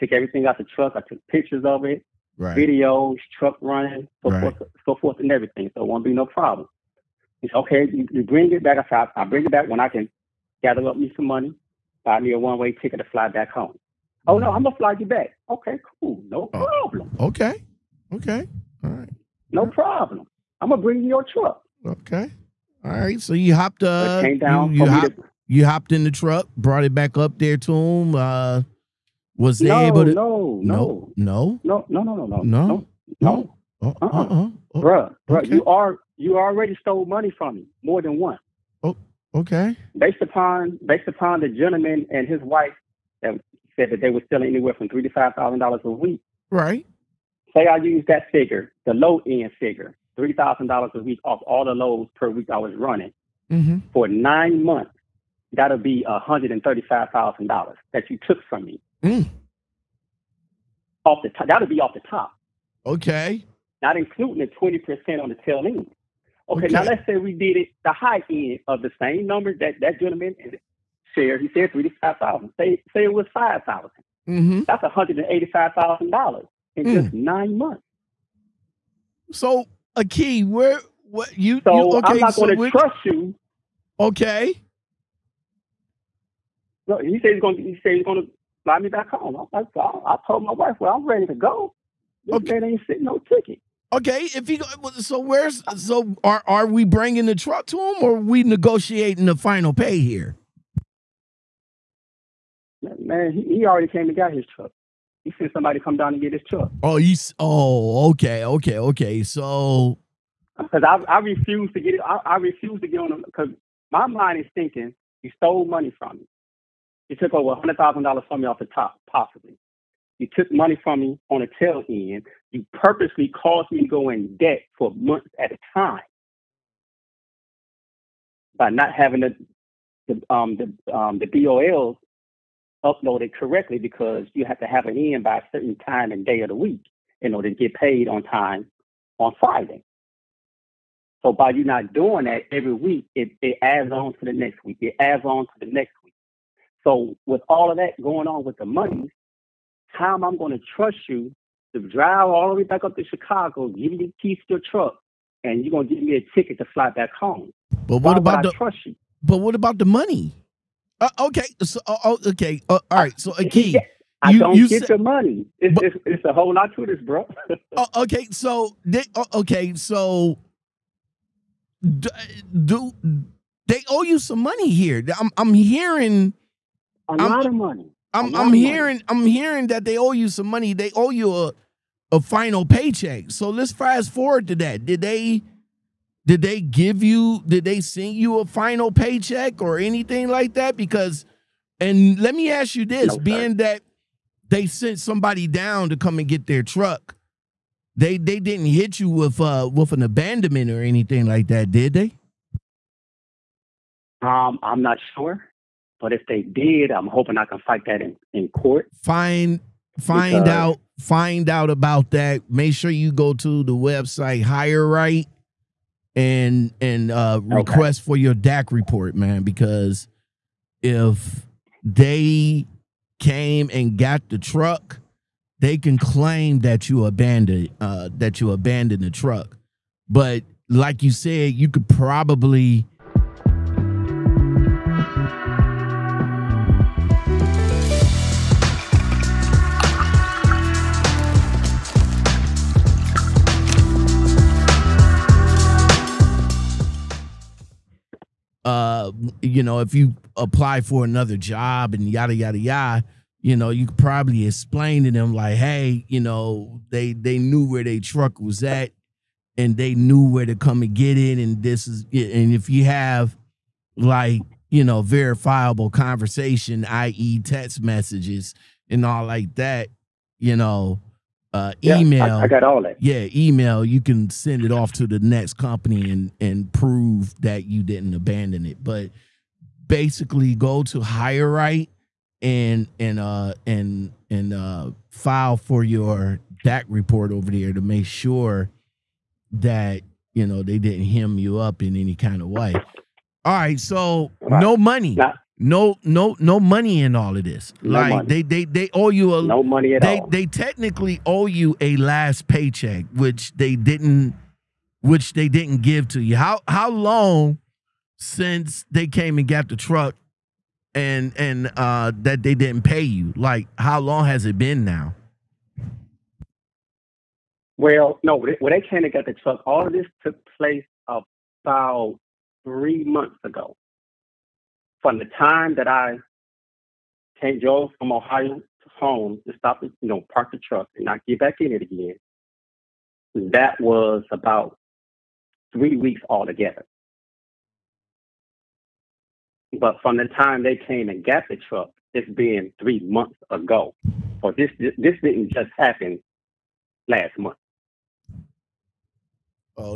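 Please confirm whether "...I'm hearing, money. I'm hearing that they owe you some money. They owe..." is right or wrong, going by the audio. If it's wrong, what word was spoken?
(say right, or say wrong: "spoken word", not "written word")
right.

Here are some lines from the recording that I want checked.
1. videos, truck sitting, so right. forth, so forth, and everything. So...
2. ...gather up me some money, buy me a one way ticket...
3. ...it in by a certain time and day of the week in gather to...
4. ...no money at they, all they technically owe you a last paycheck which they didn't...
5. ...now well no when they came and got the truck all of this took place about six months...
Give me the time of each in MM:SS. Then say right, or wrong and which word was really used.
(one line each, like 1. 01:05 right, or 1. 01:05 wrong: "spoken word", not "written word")
1. 00:02 wrong: "running", not "sitting"
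2. 00:10 right
3. 02:14 wrong: "order", not "gather"
4. 04:59 right
5. 05:14 wrong: "three", not "six".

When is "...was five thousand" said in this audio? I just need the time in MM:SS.
01:13.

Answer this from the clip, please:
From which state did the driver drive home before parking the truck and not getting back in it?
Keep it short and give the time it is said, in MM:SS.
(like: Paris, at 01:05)
Ohio, at 05:28.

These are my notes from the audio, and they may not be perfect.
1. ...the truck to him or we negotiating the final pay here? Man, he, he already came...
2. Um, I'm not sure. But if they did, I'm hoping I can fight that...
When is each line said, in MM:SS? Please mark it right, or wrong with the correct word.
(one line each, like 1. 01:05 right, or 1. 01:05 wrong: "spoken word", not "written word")
1. 01:37 right
2. 03:24 right.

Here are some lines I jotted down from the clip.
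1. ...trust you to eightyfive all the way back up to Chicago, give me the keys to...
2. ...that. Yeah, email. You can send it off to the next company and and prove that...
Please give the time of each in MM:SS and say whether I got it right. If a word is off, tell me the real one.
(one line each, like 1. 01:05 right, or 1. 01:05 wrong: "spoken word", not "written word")
1. 02:30 wrong: "drive", not "eightyfive"
2. 04:32 right.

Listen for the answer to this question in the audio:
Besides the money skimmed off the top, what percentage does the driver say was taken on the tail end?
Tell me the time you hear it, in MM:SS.
01:04.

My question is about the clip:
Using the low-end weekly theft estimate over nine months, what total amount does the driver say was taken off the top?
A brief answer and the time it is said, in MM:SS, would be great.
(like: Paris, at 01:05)
$135,000, at 00:56.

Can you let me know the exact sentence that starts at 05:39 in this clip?
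But from the time they came and got the truck, it's been three months ago.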